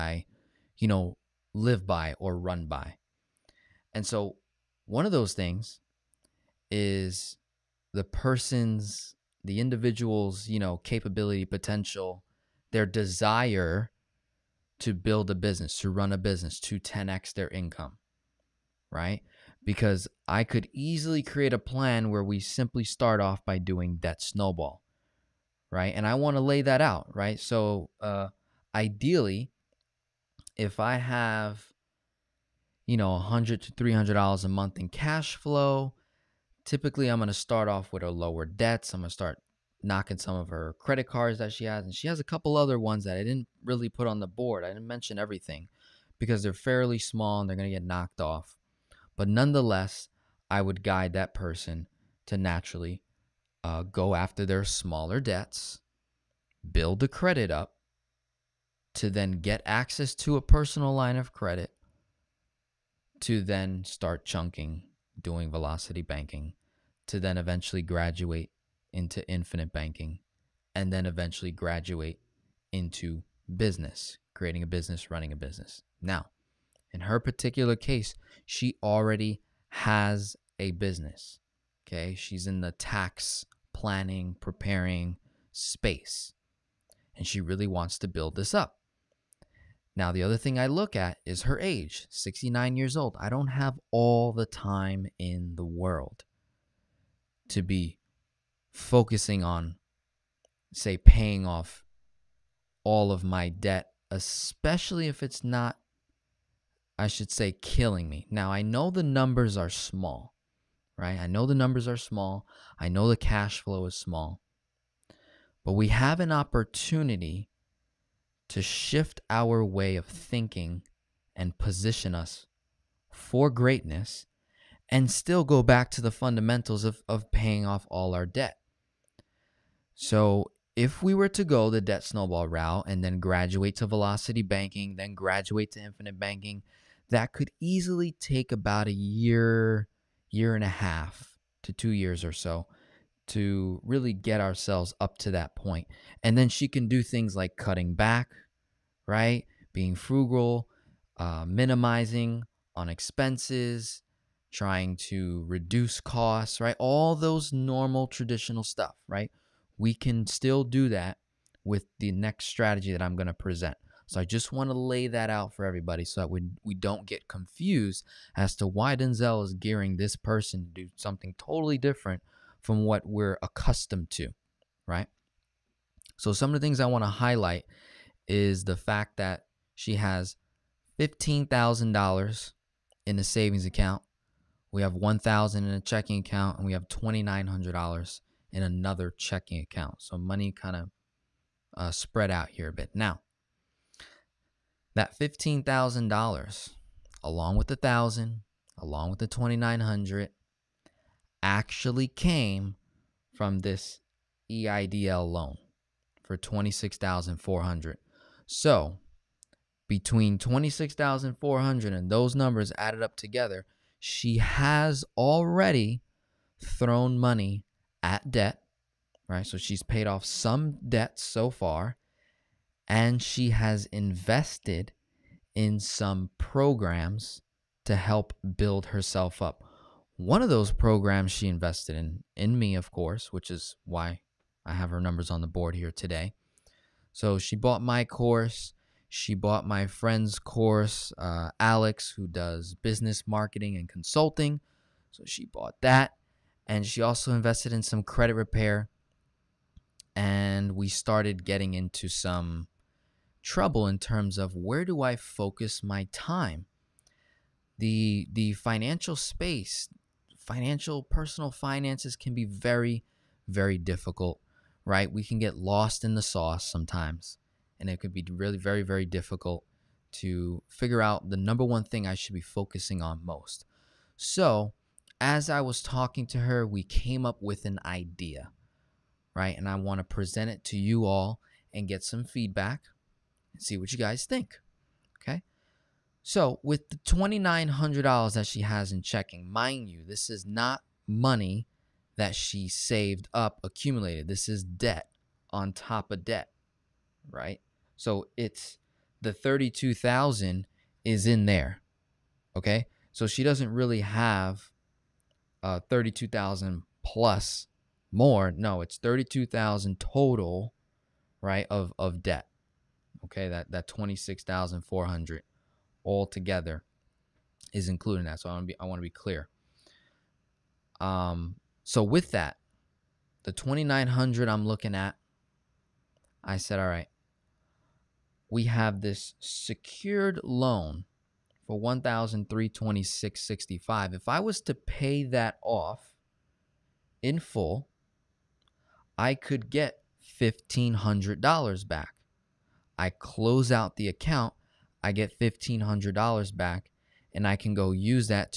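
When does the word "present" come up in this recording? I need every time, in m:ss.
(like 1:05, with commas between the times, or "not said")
2:43, 4:40.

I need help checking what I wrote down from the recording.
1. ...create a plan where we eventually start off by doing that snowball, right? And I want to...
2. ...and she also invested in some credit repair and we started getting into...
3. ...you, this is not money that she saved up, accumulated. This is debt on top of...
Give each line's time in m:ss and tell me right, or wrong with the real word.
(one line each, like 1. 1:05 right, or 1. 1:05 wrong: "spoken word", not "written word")
1. 0:21 wrong: "simply", not "eventually"
2. 4:06 right
3. 4:49 right.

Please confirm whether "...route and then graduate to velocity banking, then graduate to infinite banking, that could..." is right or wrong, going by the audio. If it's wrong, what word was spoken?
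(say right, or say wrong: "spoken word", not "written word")
right.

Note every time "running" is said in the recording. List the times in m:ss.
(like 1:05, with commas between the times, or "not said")
1:15.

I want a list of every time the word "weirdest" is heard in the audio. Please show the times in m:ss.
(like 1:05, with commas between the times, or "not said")
not said.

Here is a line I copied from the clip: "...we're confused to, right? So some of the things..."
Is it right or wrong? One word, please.
wrong.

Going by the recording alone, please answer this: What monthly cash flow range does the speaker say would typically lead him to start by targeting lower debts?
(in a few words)
100 to 300 dollars.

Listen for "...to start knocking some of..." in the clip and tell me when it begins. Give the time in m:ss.
0:39.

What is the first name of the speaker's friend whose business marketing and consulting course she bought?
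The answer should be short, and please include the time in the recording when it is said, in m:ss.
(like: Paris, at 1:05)
Alex, at 4:01.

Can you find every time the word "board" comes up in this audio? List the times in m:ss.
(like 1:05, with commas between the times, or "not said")
0:44, 3:55.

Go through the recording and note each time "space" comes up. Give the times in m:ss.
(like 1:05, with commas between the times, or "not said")
1:25, 4:19.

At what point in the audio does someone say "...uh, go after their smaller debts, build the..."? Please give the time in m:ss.
0:53.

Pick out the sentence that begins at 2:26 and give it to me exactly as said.
And then she can do things like cutting back, right?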